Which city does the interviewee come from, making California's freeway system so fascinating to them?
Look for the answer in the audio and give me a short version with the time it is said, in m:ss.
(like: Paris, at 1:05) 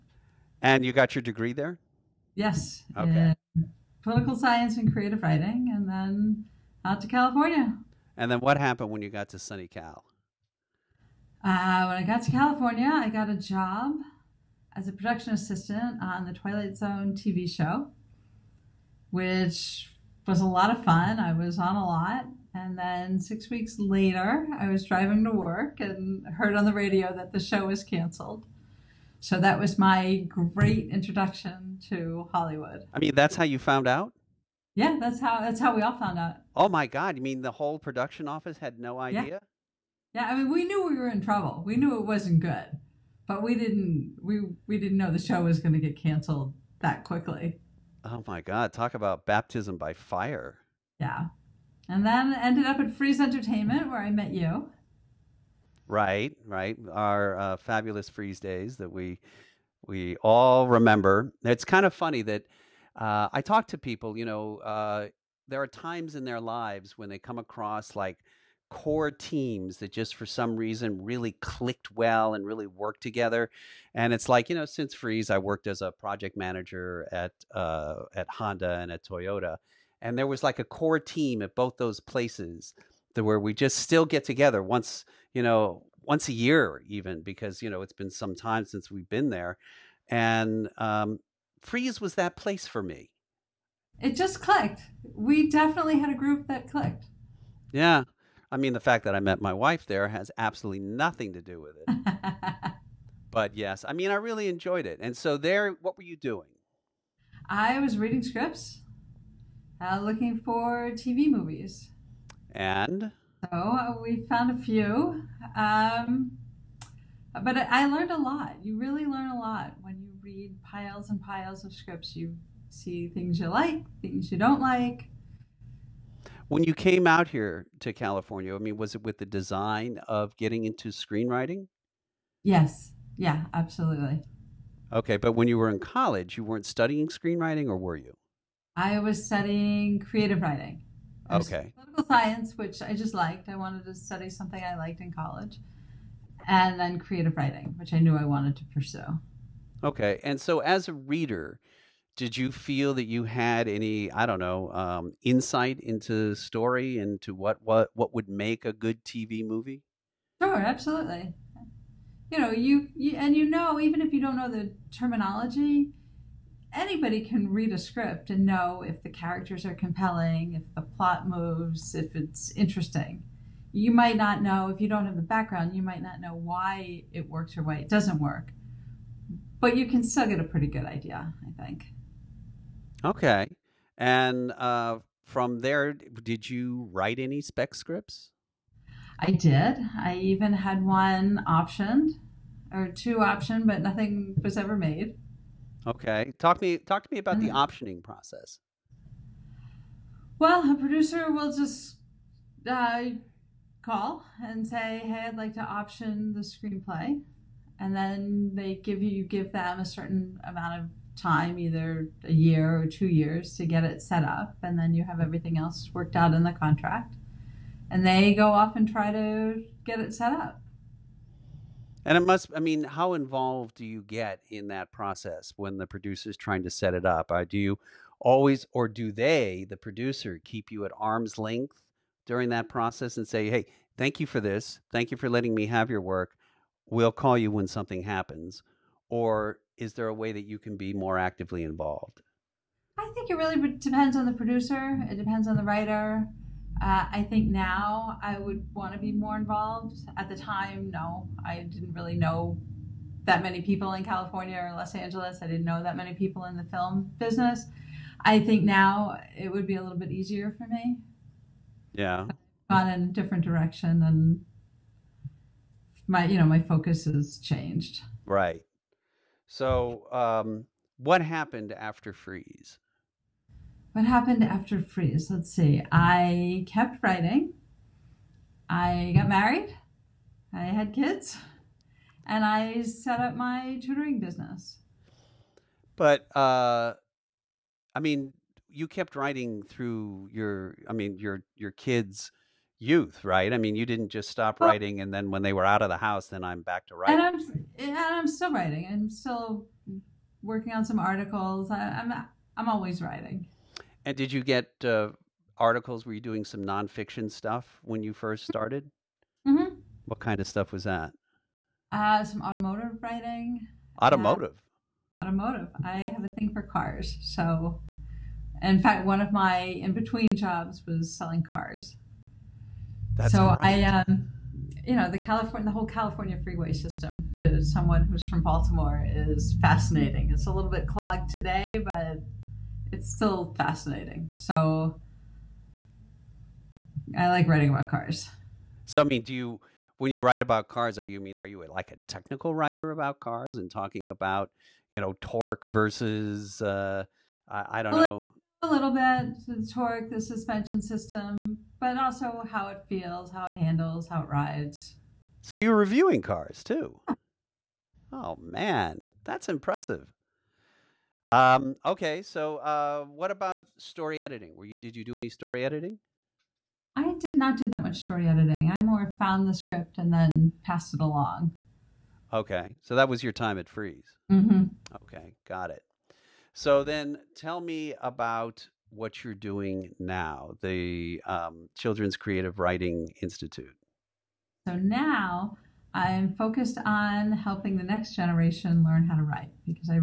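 Baltimore, at 5:28.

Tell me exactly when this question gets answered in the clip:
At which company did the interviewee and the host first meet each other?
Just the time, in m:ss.
0:52.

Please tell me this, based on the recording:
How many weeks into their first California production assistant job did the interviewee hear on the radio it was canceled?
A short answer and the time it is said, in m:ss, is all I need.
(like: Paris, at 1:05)
6, at 0:23.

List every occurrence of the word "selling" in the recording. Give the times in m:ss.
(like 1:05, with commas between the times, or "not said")
5:21.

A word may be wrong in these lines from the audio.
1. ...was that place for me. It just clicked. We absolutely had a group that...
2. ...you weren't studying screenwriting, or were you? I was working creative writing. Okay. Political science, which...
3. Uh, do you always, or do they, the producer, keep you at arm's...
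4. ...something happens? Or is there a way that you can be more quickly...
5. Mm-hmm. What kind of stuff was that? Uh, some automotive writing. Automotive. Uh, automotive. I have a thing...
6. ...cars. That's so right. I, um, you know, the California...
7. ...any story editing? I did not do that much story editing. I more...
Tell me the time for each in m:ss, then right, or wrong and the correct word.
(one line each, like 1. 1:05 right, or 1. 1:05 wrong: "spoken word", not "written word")
1. 1:31 wrong: "definitely", not "absolutely"
2. 2:16 wrong: "studying", not "working"
3. 3:47 right
4. 3:57 wrong: "actively", not "quickly"
5. 5:09 right
6. 5:21 right
7. 6:05 right.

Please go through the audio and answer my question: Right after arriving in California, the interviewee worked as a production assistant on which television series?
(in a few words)
The Twilight Zone.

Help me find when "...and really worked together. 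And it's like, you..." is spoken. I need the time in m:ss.
1:12.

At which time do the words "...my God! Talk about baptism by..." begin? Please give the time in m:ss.
0:48.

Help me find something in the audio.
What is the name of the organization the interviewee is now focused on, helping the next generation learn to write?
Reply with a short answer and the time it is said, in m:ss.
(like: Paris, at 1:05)
Children's Creative Writing Institute, at 6:21.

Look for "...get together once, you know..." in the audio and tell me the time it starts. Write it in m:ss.
1:24.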